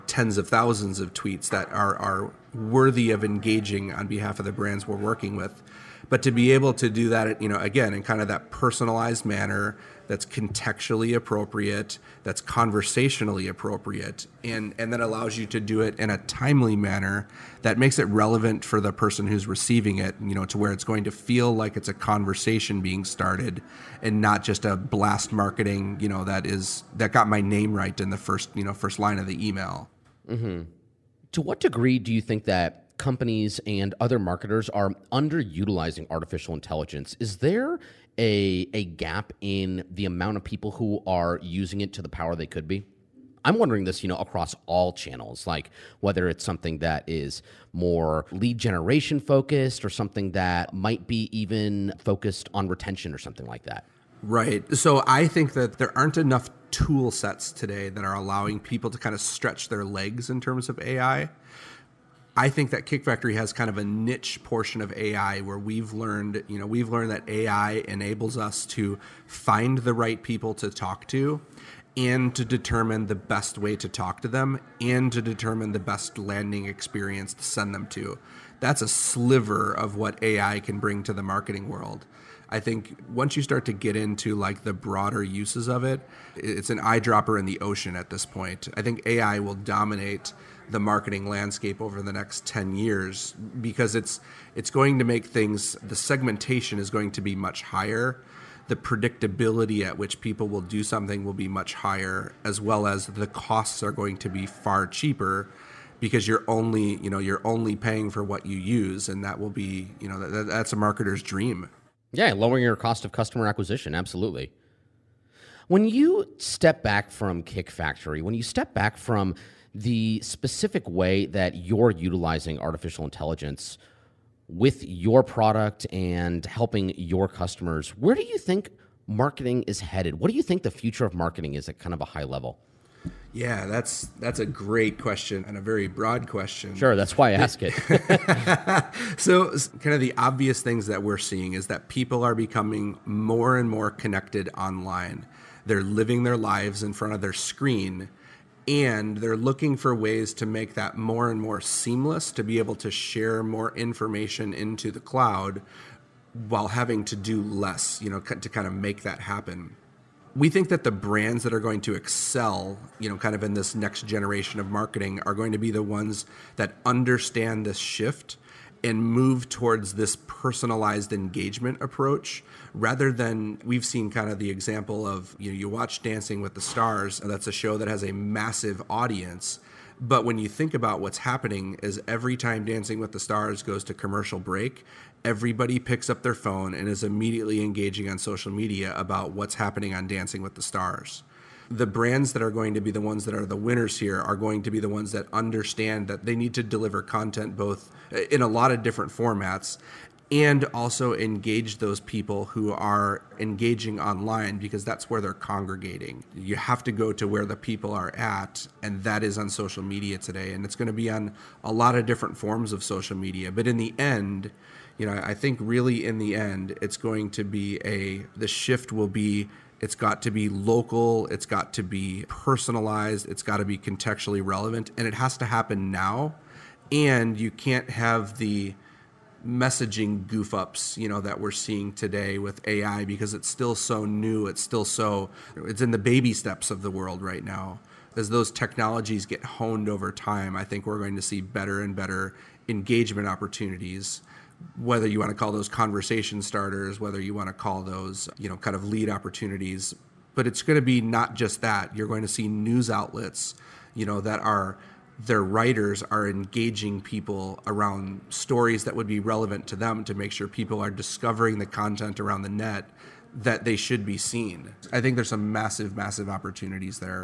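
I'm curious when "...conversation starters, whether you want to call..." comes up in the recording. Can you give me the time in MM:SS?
04:05.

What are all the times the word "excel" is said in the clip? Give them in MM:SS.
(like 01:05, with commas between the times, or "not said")
02:41.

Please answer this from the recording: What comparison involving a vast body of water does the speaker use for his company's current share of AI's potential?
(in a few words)
an eyedropper in the ocean.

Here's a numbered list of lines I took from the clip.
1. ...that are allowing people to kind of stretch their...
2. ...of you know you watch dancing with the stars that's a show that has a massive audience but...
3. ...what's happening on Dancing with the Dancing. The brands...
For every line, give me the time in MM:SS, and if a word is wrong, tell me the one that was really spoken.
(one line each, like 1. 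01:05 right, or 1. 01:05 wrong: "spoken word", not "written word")
1. 00:57 right
2. 02:55 right
3. 03:09 wrong: "Stars", not "Dancing".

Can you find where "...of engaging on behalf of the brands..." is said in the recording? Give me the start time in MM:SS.
00:03.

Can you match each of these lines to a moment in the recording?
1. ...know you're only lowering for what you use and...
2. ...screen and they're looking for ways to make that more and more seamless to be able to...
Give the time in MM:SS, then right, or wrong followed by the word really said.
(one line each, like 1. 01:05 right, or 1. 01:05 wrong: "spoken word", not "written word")
1. 01:47 wrong: "paying", not "lowering"
2. 02:27 right.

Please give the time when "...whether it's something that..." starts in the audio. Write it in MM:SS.
00:46.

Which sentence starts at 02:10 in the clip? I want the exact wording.
What do you think the future of marketing is at kind of a high level?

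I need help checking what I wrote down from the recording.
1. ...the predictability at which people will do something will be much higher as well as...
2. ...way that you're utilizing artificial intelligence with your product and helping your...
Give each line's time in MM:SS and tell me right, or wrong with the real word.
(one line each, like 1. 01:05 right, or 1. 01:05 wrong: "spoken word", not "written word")
1. 01:38 right
2. 02:00 right.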